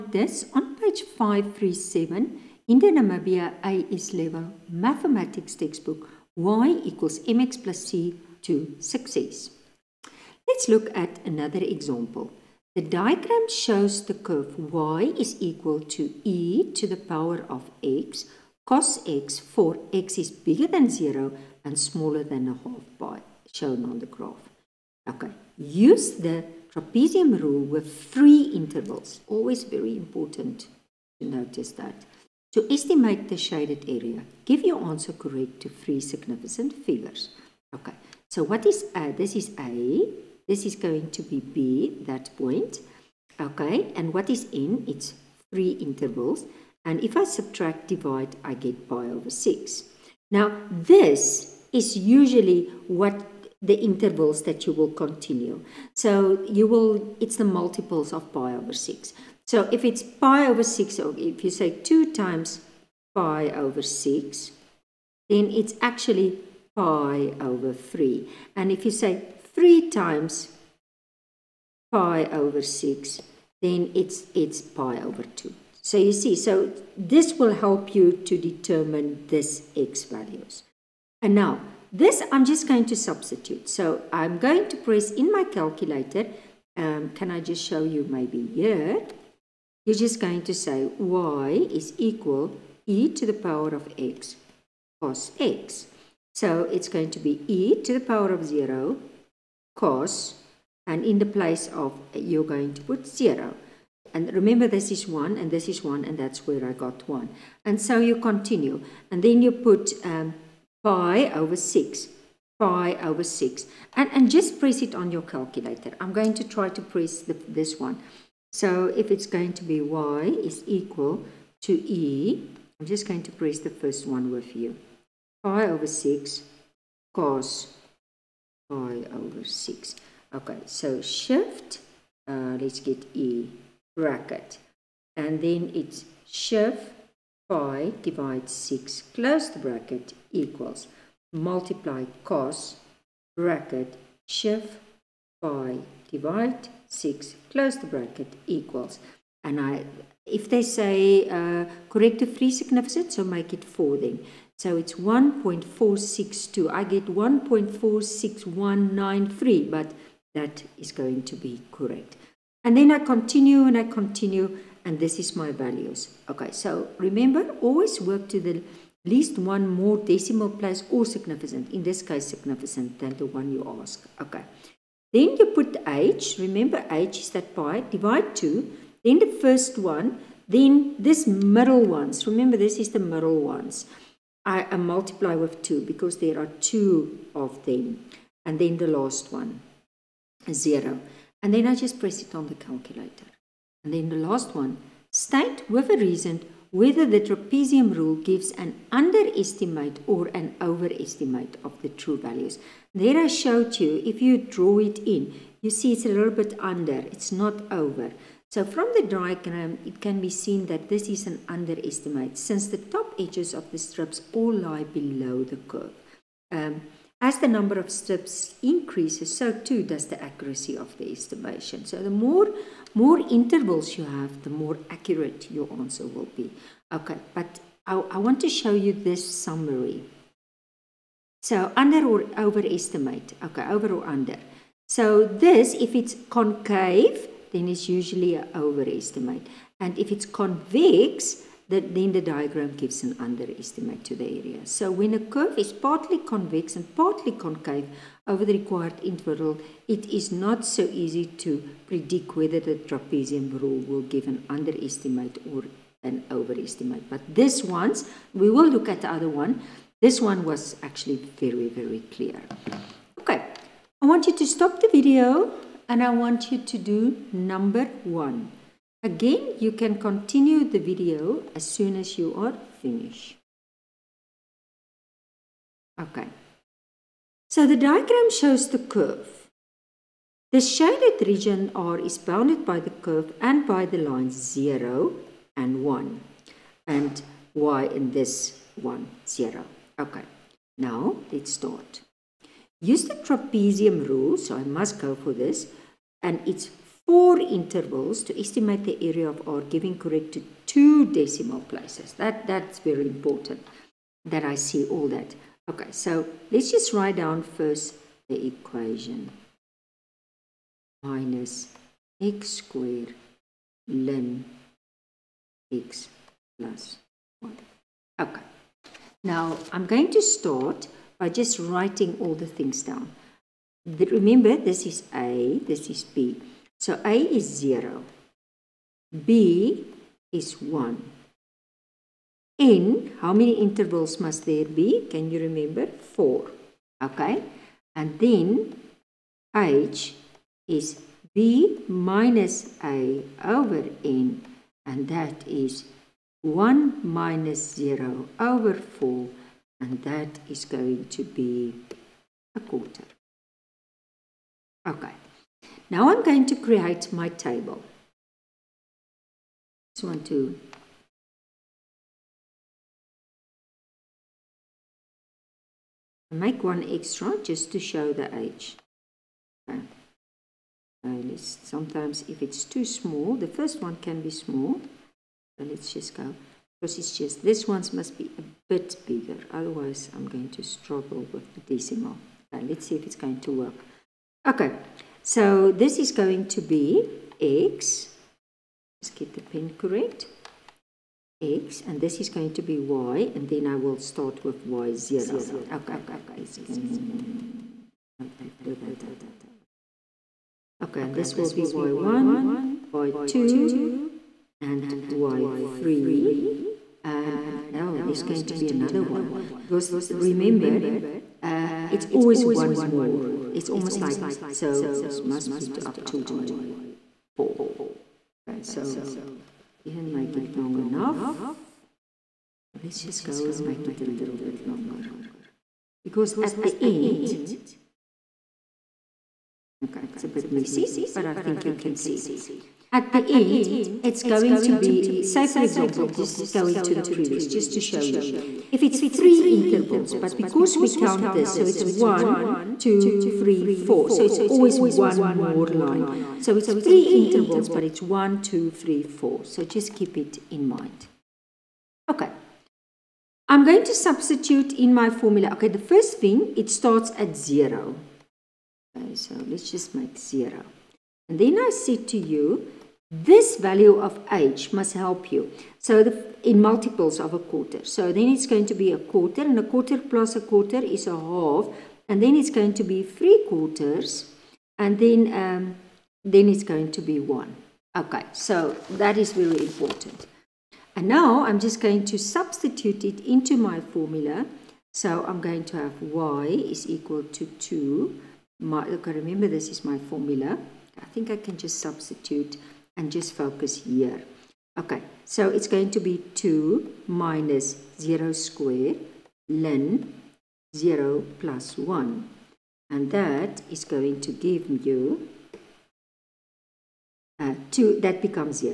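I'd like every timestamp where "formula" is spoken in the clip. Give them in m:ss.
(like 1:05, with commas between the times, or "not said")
7:35, 8:03, 8:10.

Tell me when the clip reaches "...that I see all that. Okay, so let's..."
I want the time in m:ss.
5:04.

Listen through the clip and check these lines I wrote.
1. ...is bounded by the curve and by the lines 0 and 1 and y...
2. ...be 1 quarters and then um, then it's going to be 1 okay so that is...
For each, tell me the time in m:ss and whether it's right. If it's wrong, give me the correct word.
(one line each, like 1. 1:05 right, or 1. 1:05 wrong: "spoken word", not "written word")
1. 4:41 right
2. 7:52 wrong: "3", not "1".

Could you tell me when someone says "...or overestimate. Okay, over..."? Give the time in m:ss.
3:52.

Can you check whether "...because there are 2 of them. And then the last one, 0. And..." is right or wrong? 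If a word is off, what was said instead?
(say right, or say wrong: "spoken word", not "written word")
right.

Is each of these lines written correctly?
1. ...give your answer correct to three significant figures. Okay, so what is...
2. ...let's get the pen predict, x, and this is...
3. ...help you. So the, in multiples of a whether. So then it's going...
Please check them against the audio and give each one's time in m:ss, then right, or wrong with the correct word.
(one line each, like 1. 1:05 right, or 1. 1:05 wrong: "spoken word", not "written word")
1. 0:34 right
2. 6:29 wrong: "correct", not "predict"
3. 7:44 wrong: "quarter", not "whether".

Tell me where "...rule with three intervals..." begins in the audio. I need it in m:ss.
0:27.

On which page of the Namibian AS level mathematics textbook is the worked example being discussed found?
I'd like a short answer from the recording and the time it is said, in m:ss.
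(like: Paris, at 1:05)
537, at 0:00.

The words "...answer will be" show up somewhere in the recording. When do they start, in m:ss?
3:45.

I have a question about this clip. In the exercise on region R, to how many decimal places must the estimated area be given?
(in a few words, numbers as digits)
2.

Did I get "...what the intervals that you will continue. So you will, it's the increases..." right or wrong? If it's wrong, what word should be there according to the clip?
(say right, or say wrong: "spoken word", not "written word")
wrong: "multiples", not "increases".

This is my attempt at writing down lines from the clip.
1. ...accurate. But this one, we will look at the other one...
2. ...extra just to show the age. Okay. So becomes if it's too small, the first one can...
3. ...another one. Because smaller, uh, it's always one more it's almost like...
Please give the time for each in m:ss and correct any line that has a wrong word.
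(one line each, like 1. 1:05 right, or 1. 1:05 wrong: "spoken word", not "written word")
1. 4:16 wrong: "overestimate", not "accurate"
2. 6:06 wrong: "sometimes", not "becomes"
3. 6:48 wrong: "remember", not "smaller".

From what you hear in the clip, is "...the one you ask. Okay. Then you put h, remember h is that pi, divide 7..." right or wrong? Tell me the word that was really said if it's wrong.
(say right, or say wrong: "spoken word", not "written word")
wrong: "2", not "7".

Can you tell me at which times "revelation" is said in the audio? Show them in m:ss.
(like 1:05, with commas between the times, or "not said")
not said.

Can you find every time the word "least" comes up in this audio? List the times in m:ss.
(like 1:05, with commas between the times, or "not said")
2:49.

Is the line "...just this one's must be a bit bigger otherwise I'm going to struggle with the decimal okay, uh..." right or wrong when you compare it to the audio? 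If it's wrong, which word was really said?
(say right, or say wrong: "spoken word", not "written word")
right.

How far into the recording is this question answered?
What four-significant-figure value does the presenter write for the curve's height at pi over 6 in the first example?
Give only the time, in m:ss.
2:34.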